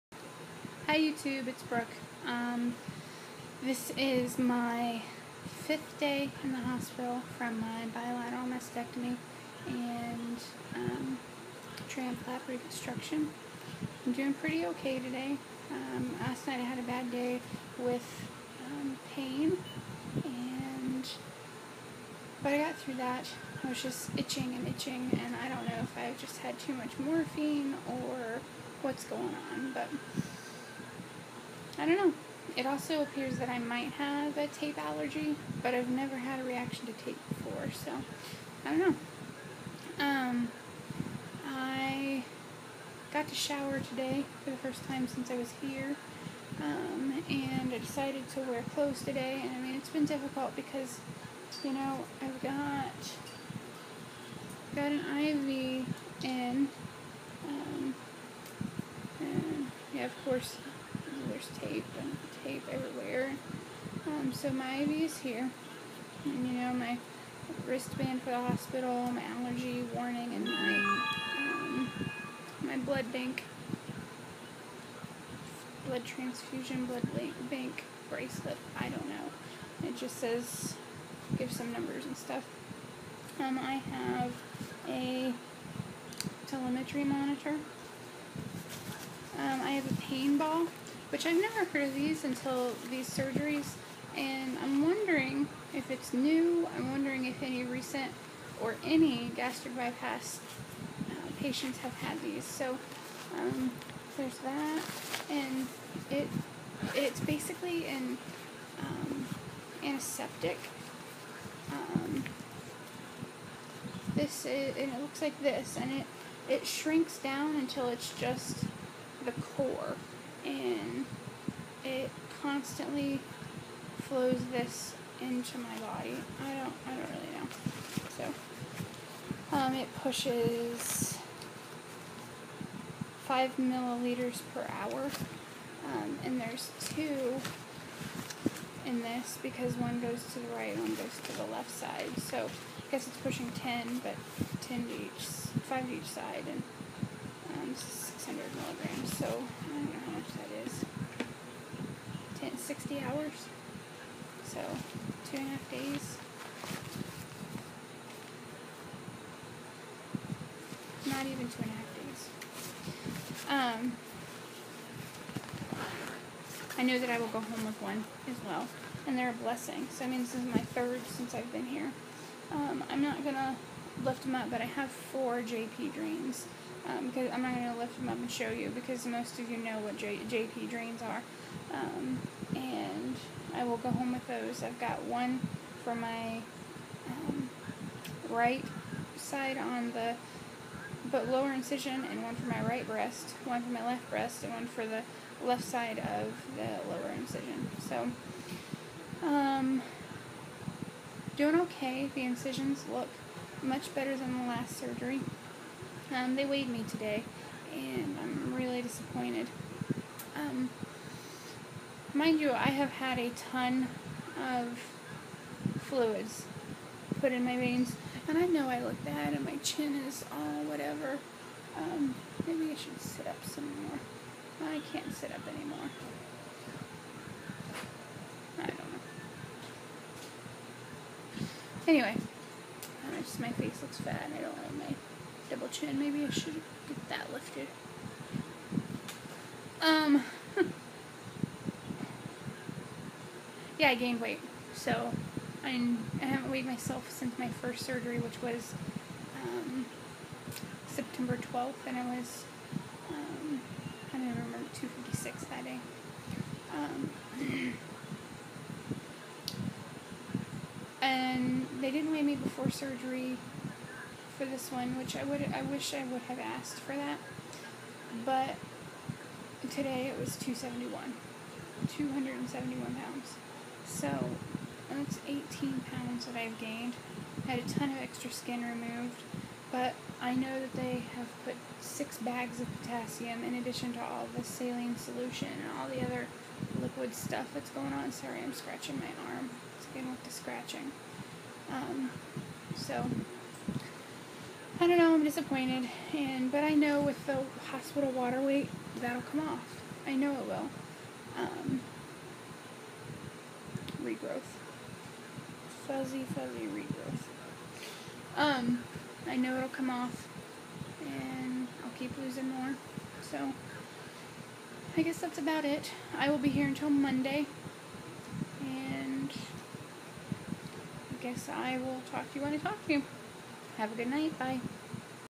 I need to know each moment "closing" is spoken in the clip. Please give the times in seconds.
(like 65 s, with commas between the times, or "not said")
not said.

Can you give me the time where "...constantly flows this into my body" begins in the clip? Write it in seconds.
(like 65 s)
122 s.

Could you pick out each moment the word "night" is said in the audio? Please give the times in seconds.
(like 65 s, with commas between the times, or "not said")
16 s, 324 s.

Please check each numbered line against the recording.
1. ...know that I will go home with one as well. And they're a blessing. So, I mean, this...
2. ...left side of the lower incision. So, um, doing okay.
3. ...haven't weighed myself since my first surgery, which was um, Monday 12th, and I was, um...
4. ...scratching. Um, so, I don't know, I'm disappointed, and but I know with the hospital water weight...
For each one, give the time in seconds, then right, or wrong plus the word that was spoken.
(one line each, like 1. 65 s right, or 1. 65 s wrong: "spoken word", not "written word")
1. 166 s right
2. 195 s right
3. 246 s wrong: "September", not "Monday"
4. 290 s right.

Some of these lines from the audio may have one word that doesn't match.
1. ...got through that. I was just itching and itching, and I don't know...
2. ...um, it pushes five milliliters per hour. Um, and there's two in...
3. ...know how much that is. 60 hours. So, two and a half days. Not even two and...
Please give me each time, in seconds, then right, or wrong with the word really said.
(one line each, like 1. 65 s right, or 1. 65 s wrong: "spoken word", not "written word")
1. 22 s right
2. 129 s right
3. 149 s right.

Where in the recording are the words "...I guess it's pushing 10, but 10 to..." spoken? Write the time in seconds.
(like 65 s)
142 s.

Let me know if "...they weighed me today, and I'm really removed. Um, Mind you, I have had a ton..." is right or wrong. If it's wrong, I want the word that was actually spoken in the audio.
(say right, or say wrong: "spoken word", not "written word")
wrong: "disappointed", not "removed".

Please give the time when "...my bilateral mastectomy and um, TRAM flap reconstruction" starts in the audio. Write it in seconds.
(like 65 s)
7 s.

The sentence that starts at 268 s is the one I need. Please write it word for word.
But today it was 271, 271 pounds.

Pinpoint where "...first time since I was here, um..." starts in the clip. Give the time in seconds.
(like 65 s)
44 s.